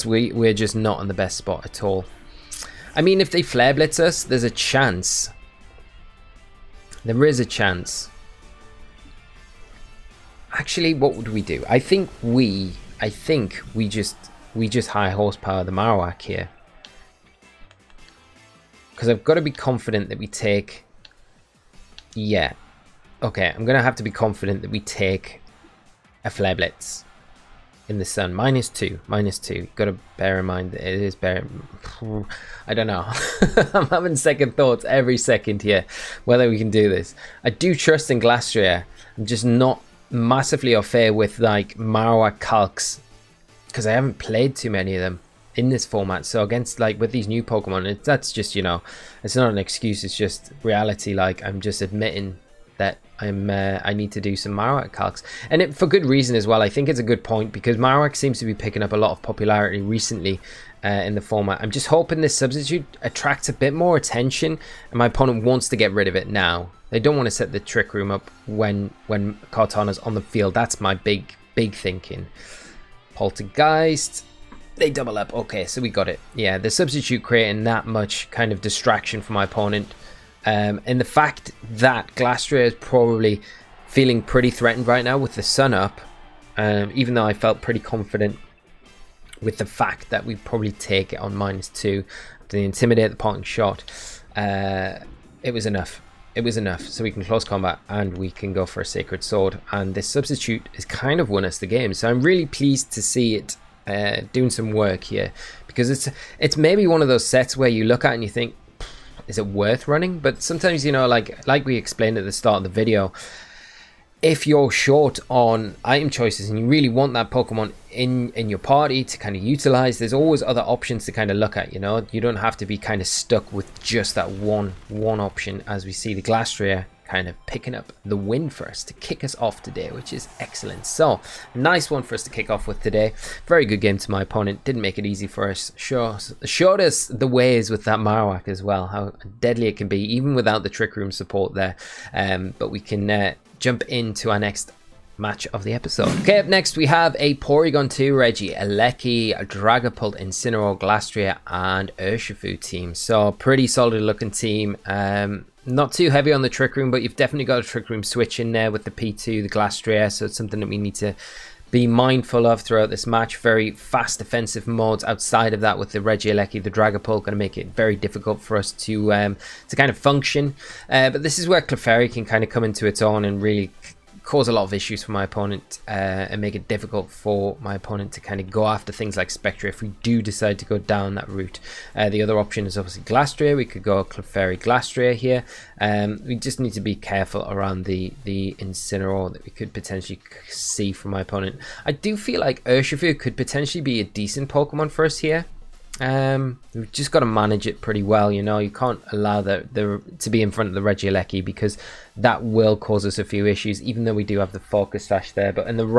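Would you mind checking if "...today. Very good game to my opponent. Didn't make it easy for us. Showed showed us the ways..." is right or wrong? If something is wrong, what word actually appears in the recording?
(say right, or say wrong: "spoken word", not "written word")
right.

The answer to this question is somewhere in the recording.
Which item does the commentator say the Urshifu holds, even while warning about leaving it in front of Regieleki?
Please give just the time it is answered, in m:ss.
3:24.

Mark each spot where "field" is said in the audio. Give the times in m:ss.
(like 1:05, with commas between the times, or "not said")
1:10.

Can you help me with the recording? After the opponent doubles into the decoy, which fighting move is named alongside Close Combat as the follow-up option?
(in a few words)
Sacred Sword.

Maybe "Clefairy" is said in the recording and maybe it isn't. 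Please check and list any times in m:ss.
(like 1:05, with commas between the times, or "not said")
2:51, 3:04.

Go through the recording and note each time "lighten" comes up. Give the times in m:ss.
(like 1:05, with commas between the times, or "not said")
not said.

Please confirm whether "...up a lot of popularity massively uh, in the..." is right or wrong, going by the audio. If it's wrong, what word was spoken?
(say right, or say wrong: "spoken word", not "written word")
wrong: "recently", not "massively".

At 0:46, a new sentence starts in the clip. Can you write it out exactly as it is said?
So against like with these new Pokemon, it, that's just you know, it's not an excuse.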